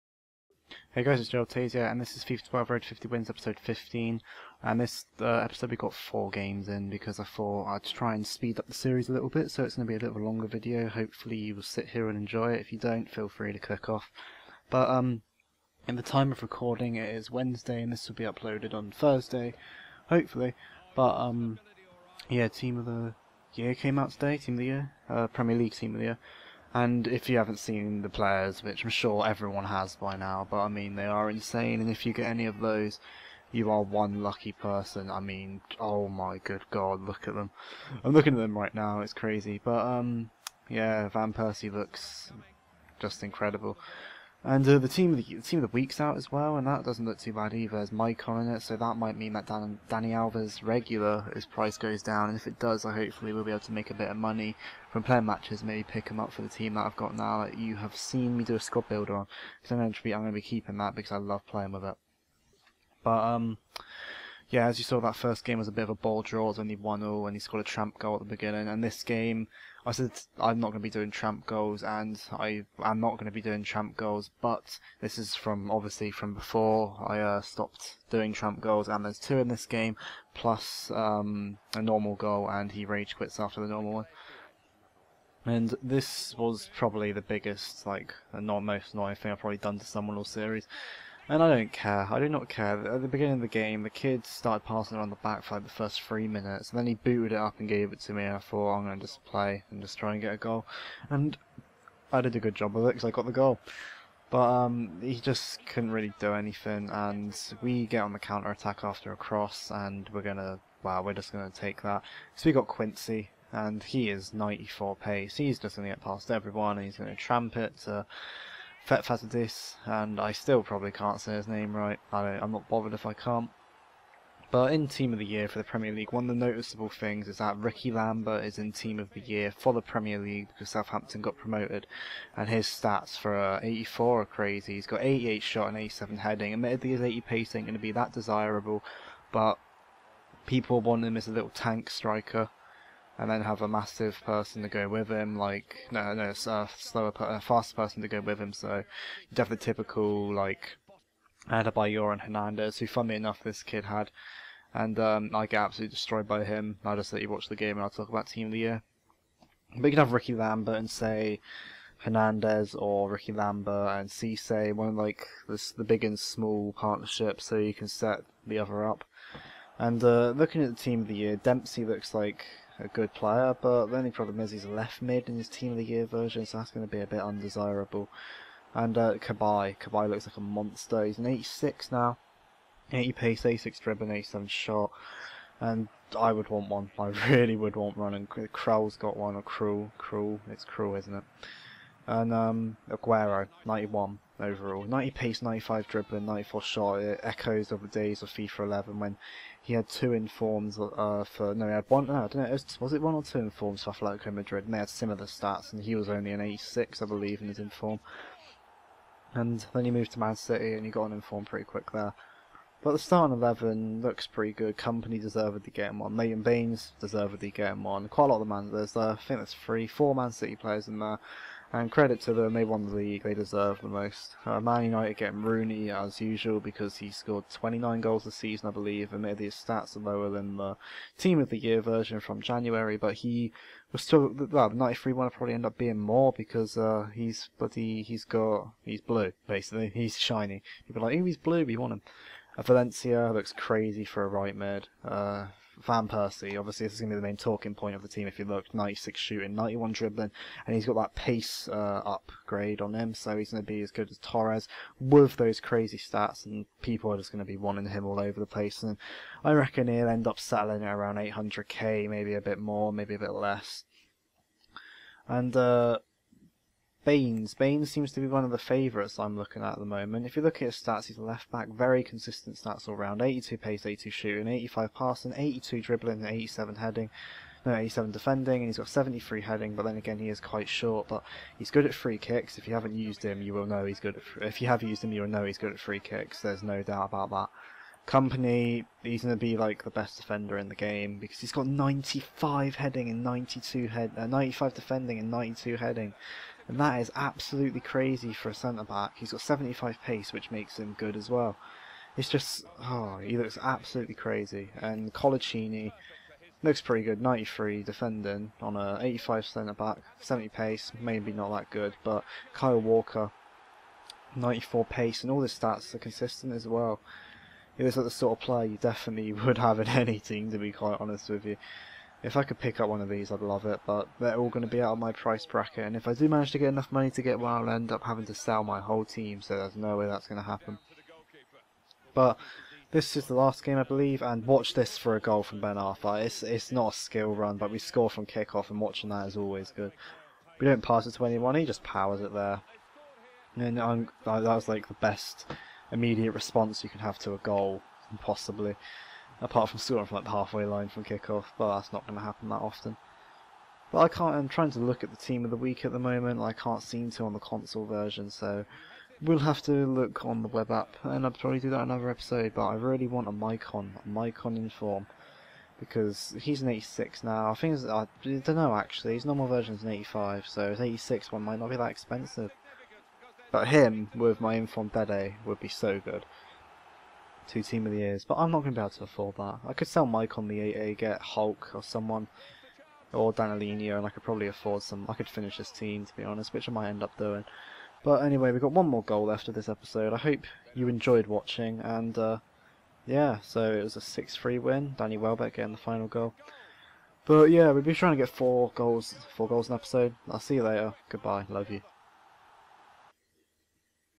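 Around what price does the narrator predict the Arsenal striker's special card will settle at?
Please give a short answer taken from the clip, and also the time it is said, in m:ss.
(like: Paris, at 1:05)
800k, at 4:21.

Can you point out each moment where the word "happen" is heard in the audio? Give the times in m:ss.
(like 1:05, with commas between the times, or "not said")
5:30, 5:52.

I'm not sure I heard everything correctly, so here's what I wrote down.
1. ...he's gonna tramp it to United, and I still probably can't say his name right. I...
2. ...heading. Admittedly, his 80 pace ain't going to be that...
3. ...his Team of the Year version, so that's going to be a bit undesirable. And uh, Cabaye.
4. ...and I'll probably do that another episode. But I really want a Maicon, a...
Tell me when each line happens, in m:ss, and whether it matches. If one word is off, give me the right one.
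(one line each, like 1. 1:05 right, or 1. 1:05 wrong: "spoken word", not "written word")
1. 1:56 wrong: "Fetfatzidis", not "United"
2. 2:16 right
3. 2:55 right
4. 6:01 right.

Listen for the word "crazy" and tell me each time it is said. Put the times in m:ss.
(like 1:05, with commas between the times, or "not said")
0:39, 2:14, 4:03, 4:15, 4:57, 5:04.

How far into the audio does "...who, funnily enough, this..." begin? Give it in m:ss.
2:32.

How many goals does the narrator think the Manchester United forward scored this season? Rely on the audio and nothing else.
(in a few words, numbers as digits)
29.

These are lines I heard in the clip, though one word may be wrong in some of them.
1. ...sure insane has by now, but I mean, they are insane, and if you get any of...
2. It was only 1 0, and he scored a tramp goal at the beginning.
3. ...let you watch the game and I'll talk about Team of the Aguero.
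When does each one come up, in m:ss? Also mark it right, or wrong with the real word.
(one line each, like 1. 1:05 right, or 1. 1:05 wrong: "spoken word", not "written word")
1. 0:28 wrong: "everyone", not "insane"
2. 1:06 right
3. 2:37 wrong: "Year", not "Aguero".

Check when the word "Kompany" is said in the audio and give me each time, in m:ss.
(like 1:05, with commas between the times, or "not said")
3:34, 4:48.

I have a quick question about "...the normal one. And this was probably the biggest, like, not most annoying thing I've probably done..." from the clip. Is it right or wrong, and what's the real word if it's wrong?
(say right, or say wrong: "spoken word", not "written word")
right.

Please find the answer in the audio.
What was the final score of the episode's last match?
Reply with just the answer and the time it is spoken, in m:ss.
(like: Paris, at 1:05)
6-3, at 6:33.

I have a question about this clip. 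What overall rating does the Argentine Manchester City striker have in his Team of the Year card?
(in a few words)
91.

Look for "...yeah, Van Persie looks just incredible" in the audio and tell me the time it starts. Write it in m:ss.
0:40.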